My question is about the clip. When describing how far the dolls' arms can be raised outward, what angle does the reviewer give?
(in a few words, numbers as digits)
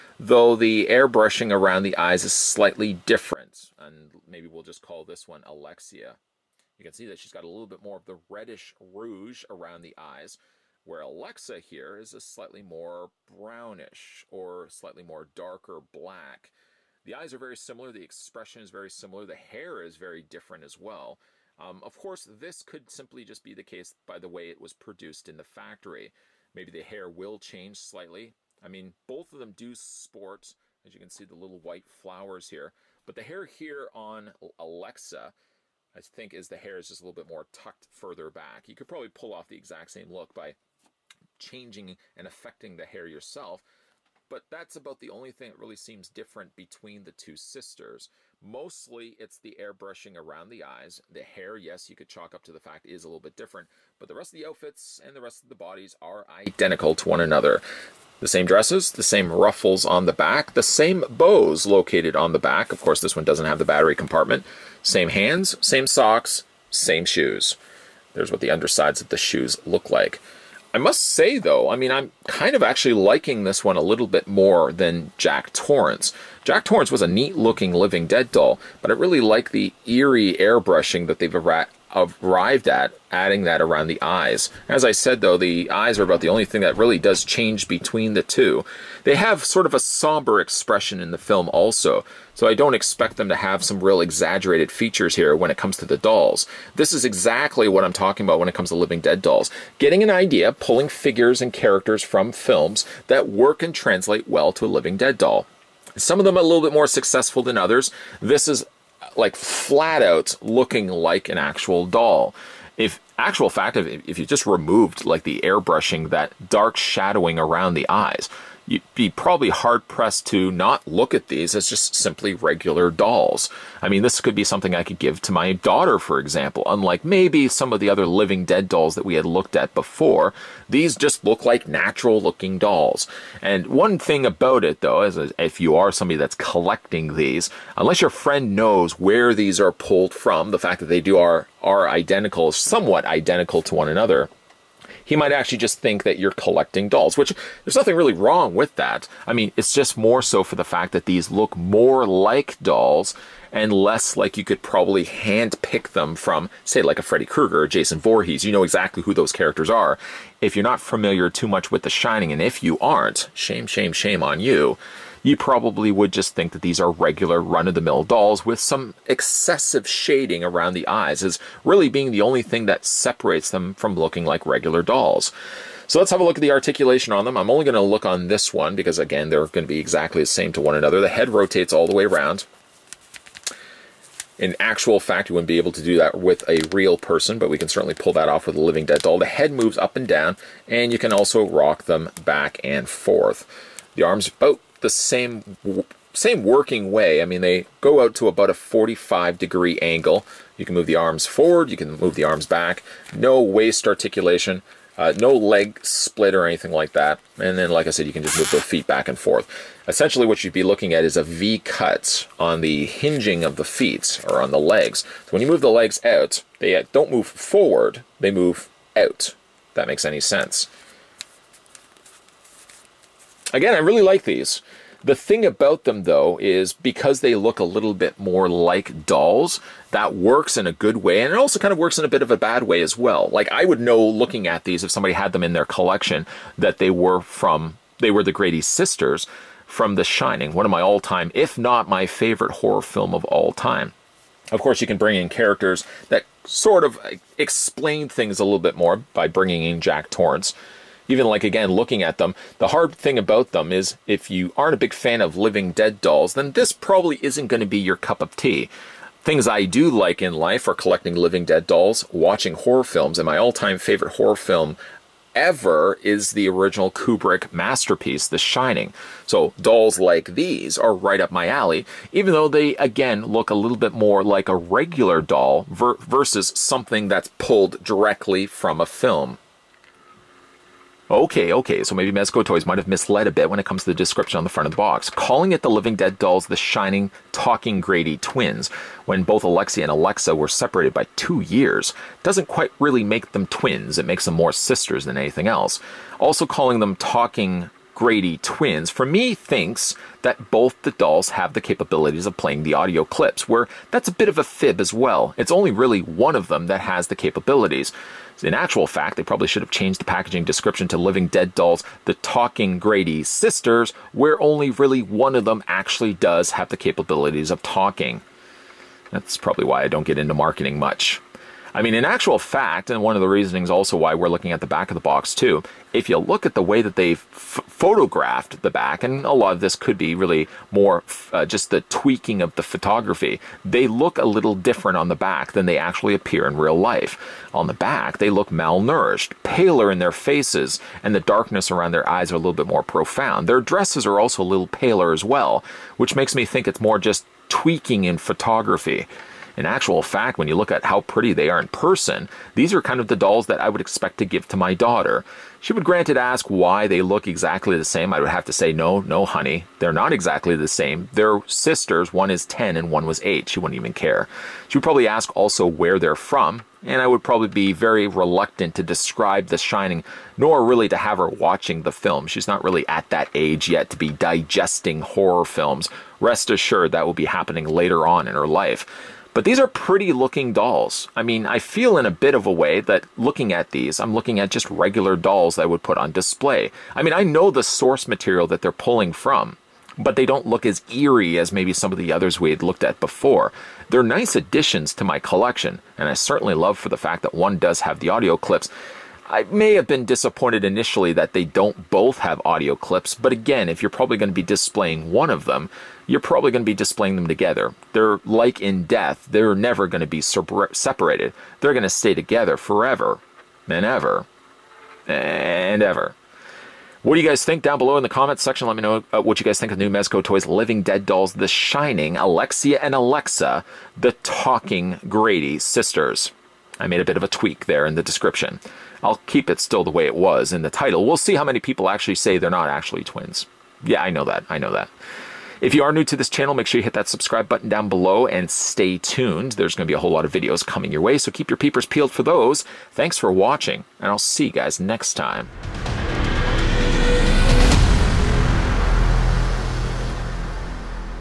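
45 degrees.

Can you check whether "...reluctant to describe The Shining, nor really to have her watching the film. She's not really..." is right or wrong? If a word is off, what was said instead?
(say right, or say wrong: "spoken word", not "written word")
right.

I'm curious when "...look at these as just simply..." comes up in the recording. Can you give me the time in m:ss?
2:00.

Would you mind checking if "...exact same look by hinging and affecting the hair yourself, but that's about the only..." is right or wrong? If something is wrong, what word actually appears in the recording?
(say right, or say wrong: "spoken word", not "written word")
wrong: "changing", not "hinging".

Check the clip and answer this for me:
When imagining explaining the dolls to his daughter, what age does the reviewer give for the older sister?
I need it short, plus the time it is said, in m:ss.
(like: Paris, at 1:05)
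10, at 6:02.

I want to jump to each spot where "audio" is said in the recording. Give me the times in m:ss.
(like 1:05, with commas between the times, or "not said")
5:02, 6:38, 6:42.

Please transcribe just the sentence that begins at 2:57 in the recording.
I'm only going to look on this one because, again, they're going to be exactly the same to one another.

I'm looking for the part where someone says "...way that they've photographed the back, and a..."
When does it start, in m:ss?
5:26.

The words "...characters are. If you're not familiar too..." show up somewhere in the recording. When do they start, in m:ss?
2:39.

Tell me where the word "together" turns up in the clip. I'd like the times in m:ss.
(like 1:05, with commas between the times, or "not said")
6:47, 6:52.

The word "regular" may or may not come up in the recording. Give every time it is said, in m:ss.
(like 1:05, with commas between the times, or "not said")
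2:02, 2:46, 2:54, 4:34, 6:24.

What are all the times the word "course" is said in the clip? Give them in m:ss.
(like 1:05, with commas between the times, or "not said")
0:21, 1:02, 4:04.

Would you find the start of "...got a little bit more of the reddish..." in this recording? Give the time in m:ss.
0:07.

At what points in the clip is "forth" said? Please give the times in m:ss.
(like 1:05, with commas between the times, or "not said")
3:12, 3:29.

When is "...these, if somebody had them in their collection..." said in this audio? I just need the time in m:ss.
3:54.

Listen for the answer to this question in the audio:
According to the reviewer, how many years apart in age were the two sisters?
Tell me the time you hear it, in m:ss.
4:51.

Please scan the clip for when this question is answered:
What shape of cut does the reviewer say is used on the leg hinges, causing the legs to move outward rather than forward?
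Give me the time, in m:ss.
3:31.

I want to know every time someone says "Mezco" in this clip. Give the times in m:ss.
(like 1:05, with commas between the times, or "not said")
4:42, 6:59.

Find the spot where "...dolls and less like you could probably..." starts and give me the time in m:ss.
2:32.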